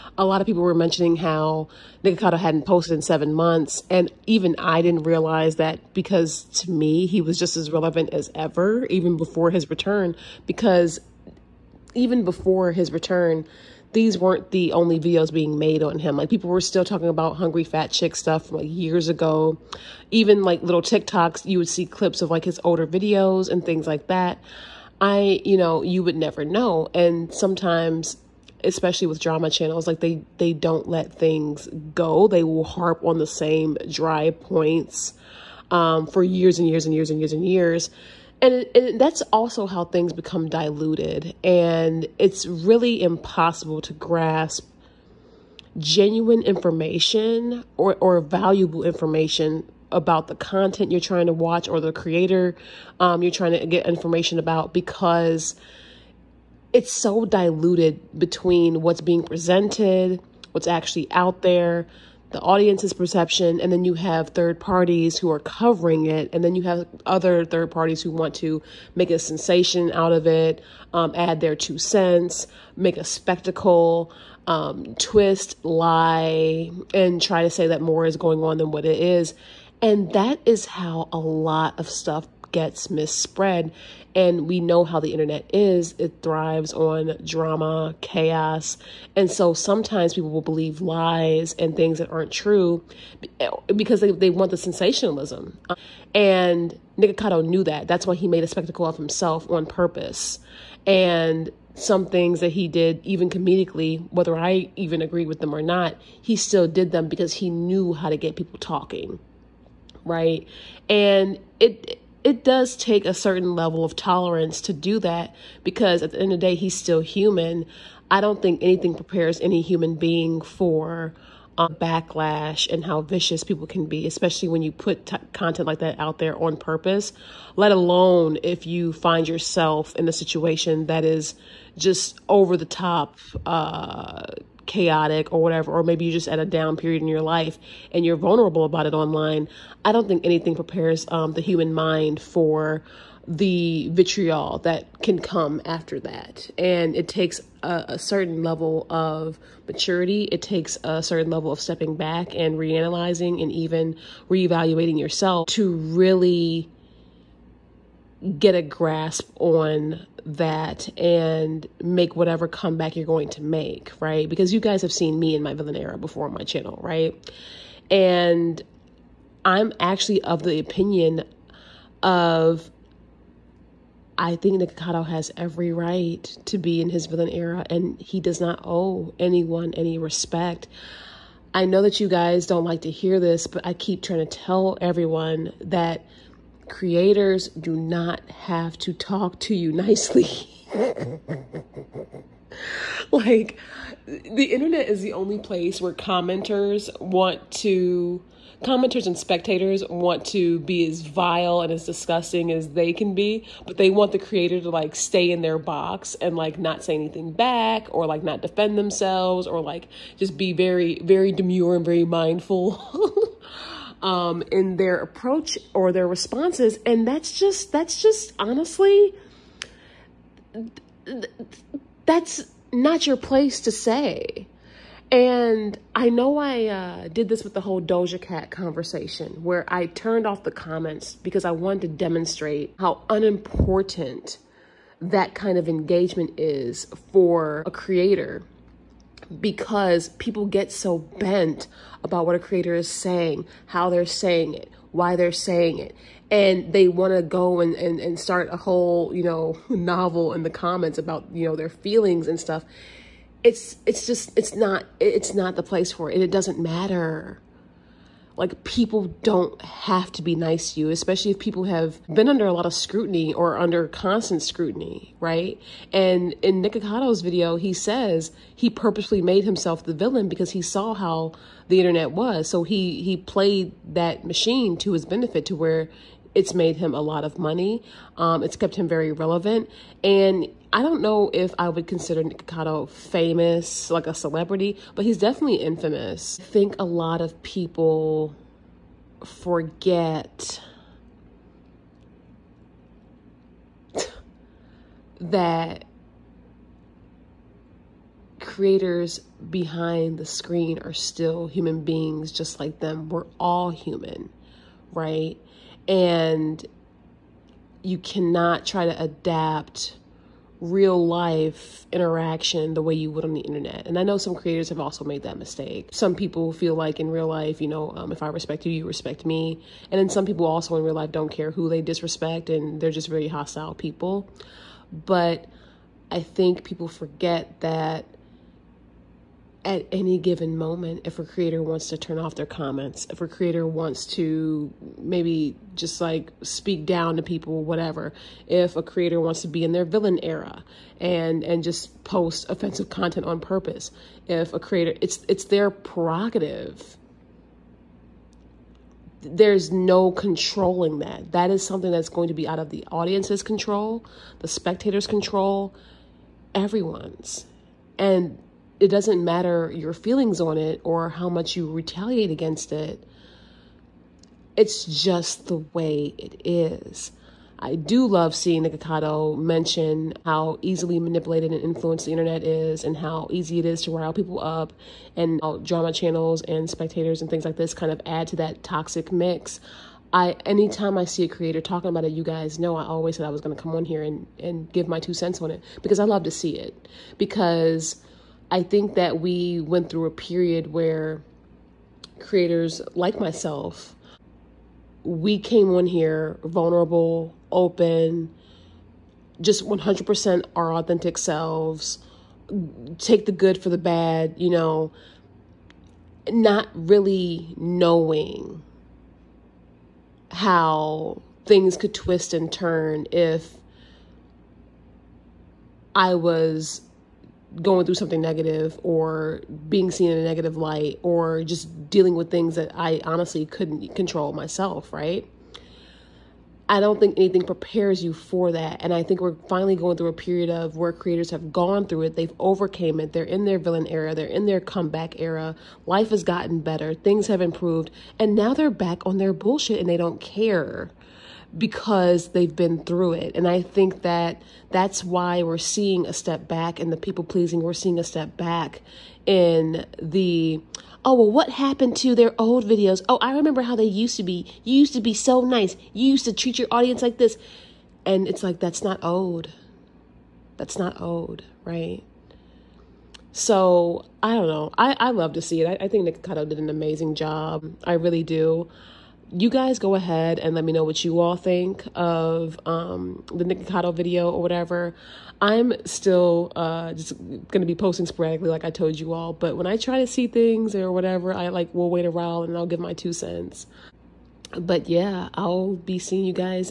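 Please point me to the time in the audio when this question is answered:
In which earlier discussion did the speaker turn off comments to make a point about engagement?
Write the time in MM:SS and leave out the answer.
03:47.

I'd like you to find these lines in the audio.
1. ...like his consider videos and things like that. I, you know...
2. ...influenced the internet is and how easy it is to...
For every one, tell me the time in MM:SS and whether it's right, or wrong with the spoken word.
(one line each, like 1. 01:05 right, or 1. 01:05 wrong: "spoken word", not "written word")
1. 00:22 wrong: "older", not "consider"
2. 06:11 right.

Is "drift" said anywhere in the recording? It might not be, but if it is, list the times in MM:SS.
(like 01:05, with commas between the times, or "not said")
not said.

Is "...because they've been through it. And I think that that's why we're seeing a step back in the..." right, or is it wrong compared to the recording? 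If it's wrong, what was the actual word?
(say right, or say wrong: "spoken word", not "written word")
right.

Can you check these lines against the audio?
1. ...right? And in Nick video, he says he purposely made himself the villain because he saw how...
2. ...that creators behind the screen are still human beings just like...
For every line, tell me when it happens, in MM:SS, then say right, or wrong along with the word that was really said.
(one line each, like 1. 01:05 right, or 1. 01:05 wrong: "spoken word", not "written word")
1. 04:25 right
2. 04:55 right.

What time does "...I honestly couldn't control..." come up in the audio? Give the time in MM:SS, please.
07:02.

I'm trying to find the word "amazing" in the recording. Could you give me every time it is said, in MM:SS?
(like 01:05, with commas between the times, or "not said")
07:46.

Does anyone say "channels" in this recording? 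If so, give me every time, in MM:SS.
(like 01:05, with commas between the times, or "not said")
00:29, 02:46, 06:15.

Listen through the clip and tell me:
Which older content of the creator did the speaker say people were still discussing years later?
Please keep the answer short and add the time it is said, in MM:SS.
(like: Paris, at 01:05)
Hungry fat chick, at 00:17.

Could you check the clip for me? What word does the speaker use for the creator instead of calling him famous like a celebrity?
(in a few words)
Infamous.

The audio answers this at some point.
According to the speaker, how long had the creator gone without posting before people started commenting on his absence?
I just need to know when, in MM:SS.
00:03.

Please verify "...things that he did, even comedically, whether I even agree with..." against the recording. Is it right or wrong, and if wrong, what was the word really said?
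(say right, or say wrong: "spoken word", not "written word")
right.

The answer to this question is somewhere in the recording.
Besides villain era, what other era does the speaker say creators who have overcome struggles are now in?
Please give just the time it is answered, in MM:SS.
07:14.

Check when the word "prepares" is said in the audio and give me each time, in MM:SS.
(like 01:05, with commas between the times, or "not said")
01:58, 02:20, 07:07.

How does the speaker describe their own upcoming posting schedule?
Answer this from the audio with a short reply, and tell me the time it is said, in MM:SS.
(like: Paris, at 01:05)
Sporadically, at 07:58.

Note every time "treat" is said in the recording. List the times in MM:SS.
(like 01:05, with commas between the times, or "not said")
07:36.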